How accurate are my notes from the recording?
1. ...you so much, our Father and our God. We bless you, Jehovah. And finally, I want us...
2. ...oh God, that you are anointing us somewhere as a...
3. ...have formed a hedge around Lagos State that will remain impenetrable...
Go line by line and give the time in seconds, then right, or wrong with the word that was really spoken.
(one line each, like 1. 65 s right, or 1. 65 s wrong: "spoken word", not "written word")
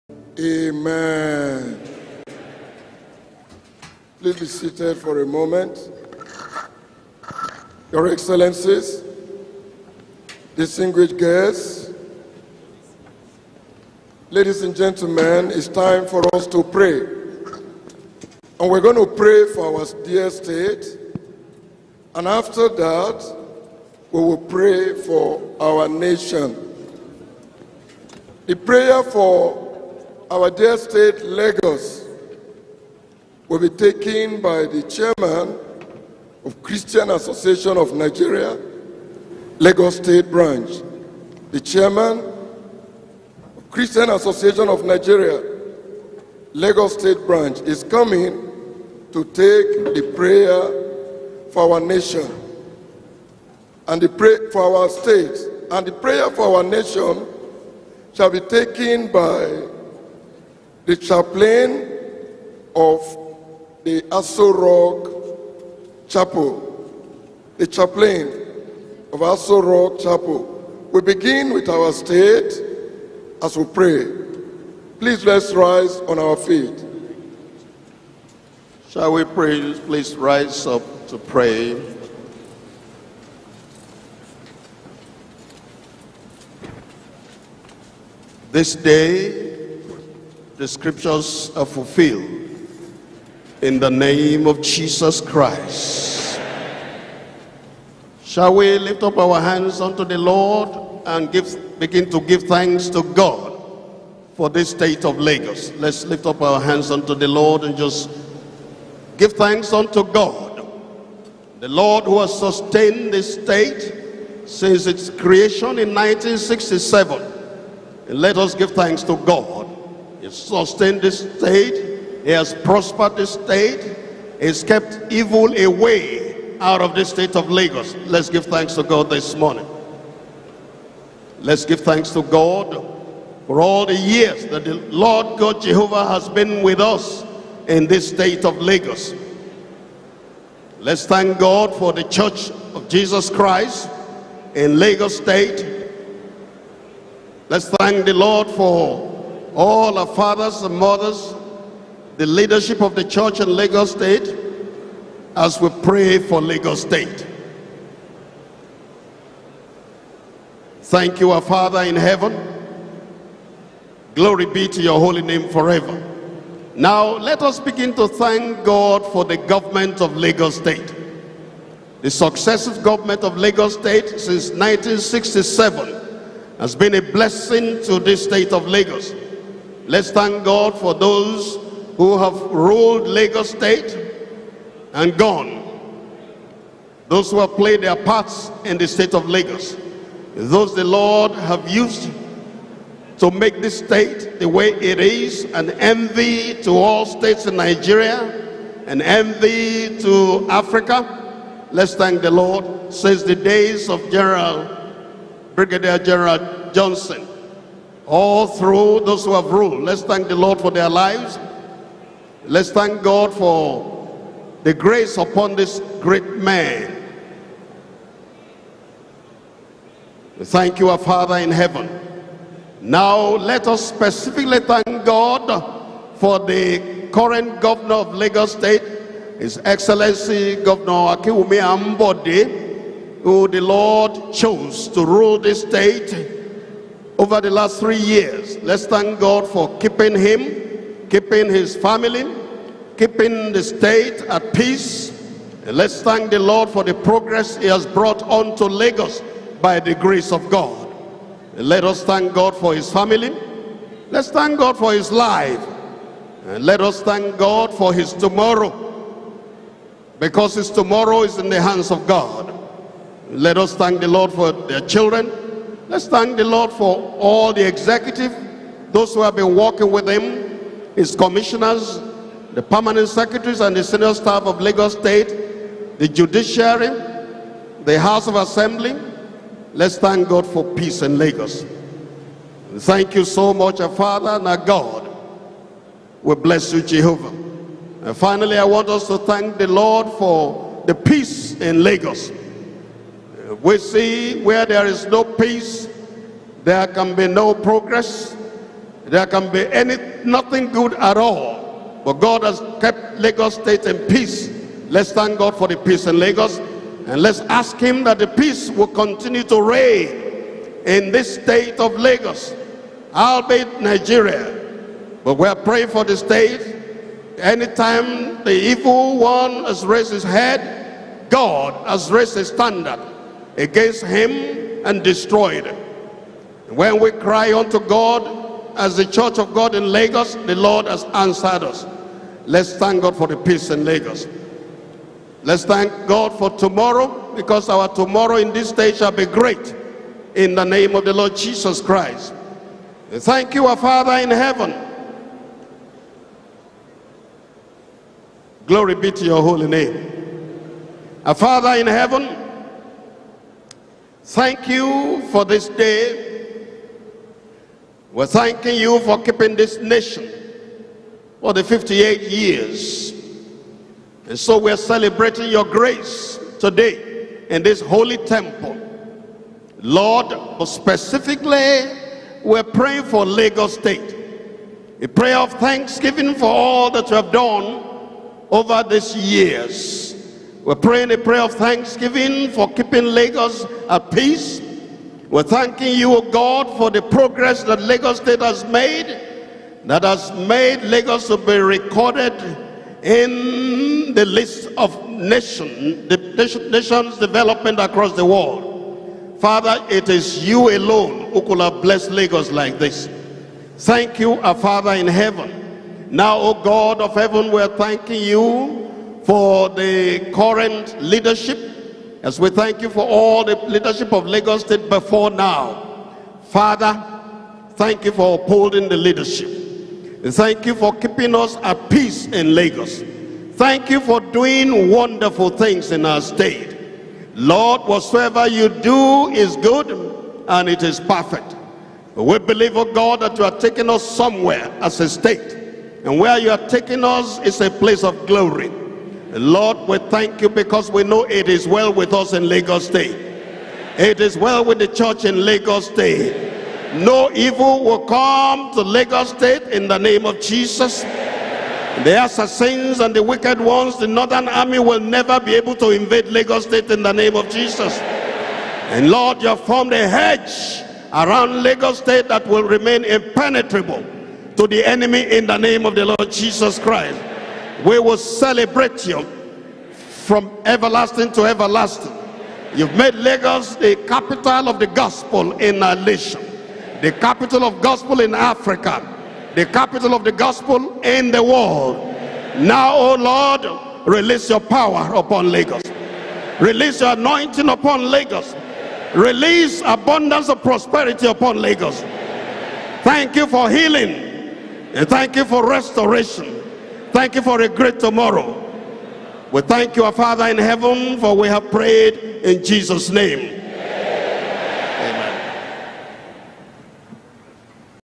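1. 283 s right
2. 432 s wrong: "taking", not "anointing"
3. 459 s right.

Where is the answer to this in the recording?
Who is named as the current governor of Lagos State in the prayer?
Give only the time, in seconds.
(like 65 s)
231 s.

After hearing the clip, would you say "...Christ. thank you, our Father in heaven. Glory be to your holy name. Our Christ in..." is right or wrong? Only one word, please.
wrong.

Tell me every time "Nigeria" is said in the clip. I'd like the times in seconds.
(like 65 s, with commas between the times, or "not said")
37 s, 44 s, 197 s, 313 s.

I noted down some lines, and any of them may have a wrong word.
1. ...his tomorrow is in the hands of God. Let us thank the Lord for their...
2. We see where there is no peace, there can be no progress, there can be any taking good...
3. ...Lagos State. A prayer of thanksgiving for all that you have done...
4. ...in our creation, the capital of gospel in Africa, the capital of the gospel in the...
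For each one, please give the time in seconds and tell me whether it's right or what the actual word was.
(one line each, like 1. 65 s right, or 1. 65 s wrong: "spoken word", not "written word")
1. 260 s right
2. 293 s wrong: "nothing", not "taking"
3. 373 s right
4. 475 s wrong: "nation", not "creation".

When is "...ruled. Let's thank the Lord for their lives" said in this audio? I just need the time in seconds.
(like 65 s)
209 s.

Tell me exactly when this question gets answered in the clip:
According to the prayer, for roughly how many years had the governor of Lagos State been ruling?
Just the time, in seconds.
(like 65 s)
237 s.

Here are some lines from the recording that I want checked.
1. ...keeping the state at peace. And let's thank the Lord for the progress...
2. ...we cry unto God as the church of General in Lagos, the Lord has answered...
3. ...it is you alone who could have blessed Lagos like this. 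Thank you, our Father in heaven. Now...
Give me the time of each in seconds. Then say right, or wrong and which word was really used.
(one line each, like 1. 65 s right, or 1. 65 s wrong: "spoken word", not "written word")
1. 242 s right
2. 326 s wrong: "God", not "General"
3. 399 s right.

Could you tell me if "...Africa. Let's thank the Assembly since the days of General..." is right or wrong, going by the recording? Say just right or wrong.
wrong.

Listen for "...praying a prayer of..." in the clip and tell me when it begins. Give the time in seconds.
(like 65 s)
380 s.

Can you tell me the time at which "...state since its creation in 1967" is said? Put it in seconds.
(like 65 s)
113 s.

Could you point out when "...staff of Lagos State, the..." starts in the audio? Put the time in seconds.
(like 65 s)
274 s.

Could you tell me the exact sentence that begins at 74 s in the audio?
Please let's rise on our feet.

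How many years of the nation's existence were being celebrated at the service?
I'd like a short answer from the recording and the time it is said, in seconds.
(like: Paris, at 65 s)
58, at 361 s.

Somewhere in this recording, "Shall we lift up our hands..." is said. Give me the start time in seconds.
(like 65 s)
98 s.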